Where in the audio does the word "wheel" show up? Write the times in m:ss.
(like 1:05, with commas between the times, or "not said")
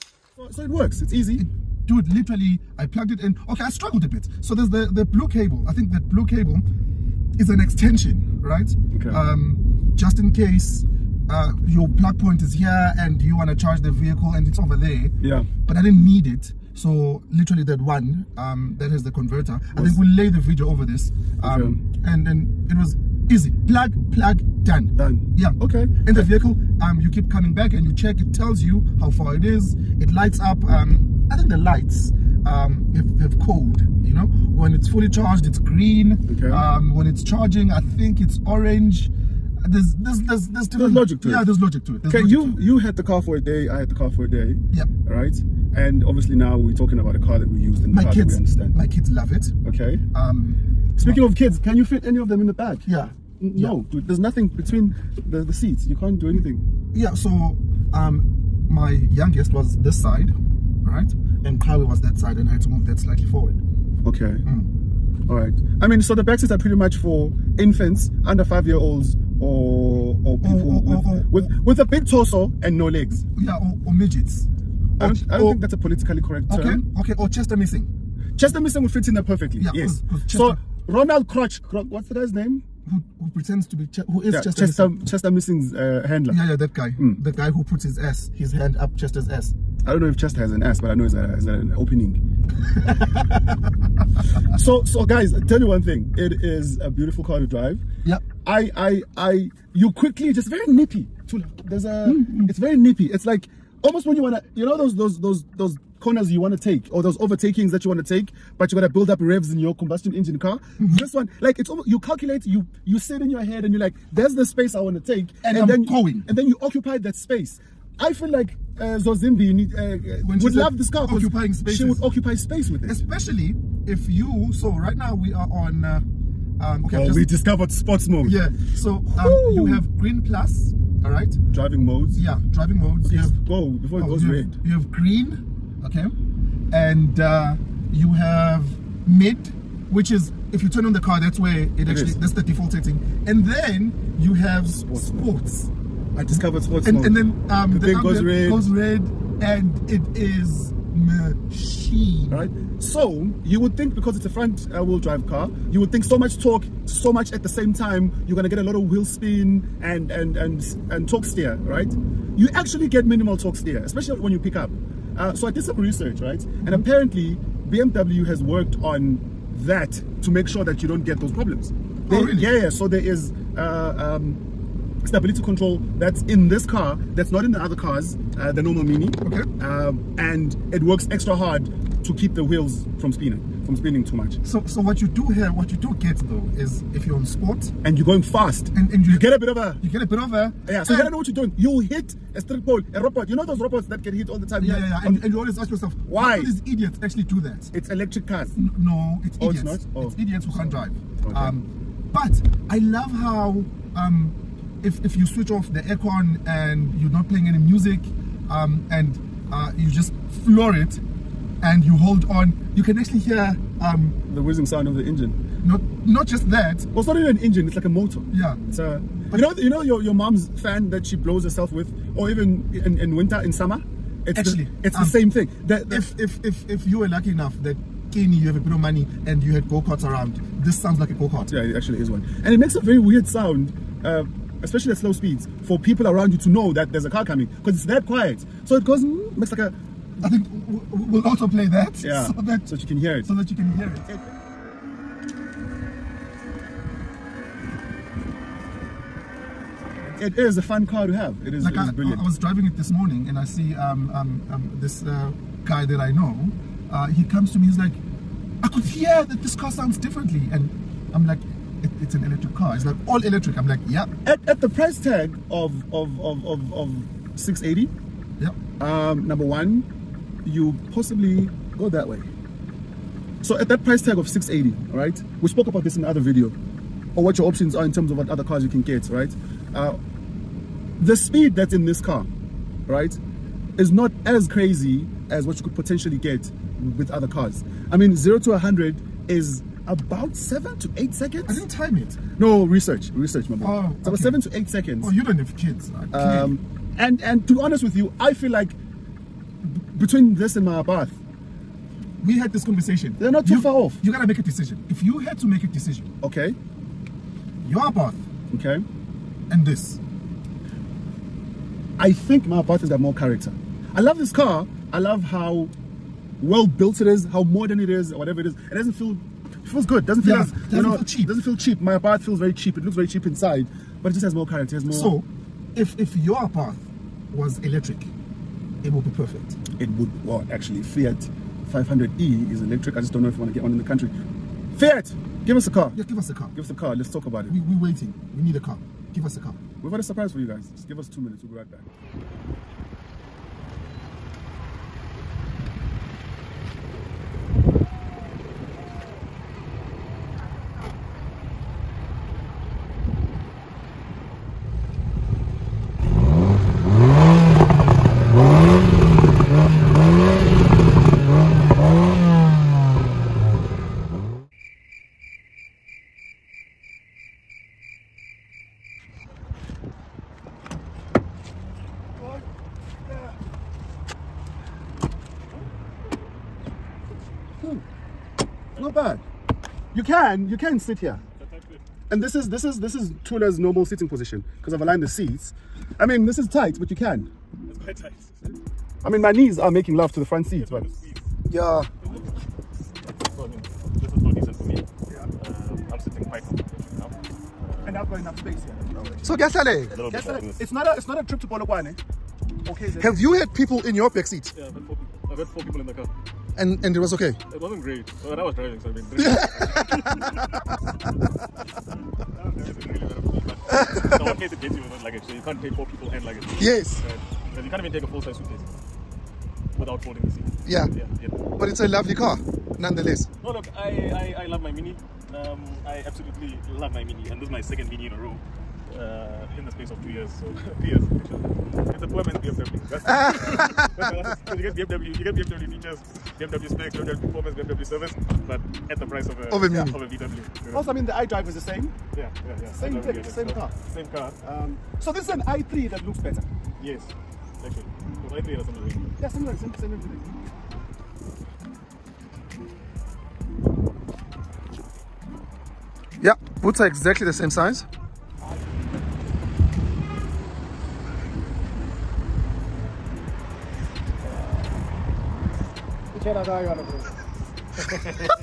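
2:34, 2:38, 3:02.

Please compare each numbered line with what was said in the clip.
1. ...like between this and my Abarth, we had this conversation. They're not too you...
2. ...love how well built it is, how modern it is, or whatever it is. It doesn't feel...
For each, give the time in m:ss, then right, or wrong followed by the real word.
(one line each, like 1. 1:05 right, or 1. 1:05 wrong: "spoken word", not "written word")
1. 4:58 right
2. 5:14 right.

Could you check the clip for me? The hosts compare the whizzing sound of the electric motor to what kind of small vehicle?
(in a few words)
Go kart.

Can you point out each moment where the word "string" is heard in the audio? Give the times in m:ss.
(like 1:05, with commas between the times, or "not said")
3:12.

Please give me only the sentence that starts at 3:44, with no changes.
It's Actually, the, it's um, the same thing.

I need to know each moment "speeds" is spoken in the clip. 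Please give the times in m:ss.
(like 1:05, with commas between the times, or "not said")
3:55, 4:41.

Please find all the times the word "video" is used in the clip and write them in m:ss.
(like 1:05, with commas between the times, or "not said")
0:20, 4:36.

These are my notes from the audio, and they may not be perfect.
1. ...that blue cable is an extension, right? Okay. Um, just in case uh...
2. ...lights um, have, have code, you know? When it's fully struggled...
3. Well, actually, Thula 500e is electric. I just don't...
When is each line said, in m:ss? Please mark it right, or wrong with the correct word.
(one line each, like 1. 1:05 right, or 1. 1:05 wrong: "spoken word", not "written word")
1. 0:05 right
2. 0:31 wrong: "charged", not "struggled"
3. 5:30 wrong: "Fiat", not "Thula".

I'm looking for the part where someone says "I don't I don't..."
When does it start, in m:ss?
1:15.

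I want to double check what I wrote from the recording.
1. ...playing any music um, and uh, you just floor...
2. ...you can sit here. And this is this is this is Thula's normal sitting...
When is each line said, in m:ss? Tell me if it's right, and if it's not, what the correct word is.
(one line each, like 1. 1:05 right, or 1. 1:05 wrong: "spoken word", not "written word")
1. 3:27 right
2. 6:20 right.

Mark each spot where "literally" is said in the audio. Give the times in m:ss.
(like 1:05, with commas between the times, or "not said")
0:02, 0:17.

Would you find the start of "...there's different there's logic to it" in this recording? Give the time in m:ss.
0:40.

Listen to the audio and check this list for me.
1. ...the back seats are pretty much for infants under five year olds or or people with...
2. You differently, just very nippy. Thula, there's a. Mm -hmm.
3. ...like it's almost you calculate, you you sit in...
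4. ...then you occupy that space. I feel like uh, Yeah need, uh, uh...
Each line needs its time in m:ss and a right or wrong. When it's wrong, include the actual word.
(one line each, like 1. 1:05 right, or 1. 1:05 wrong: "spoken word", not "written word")
1. 1:06 right
2. 1:39 wrong: "quickly", not "differently"
3. 1:51 right
4. 1:56 wrong: "Zozibini", not "Yeah".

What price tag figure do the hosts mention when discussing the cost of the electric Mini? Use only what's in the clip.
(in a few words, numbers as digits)
680.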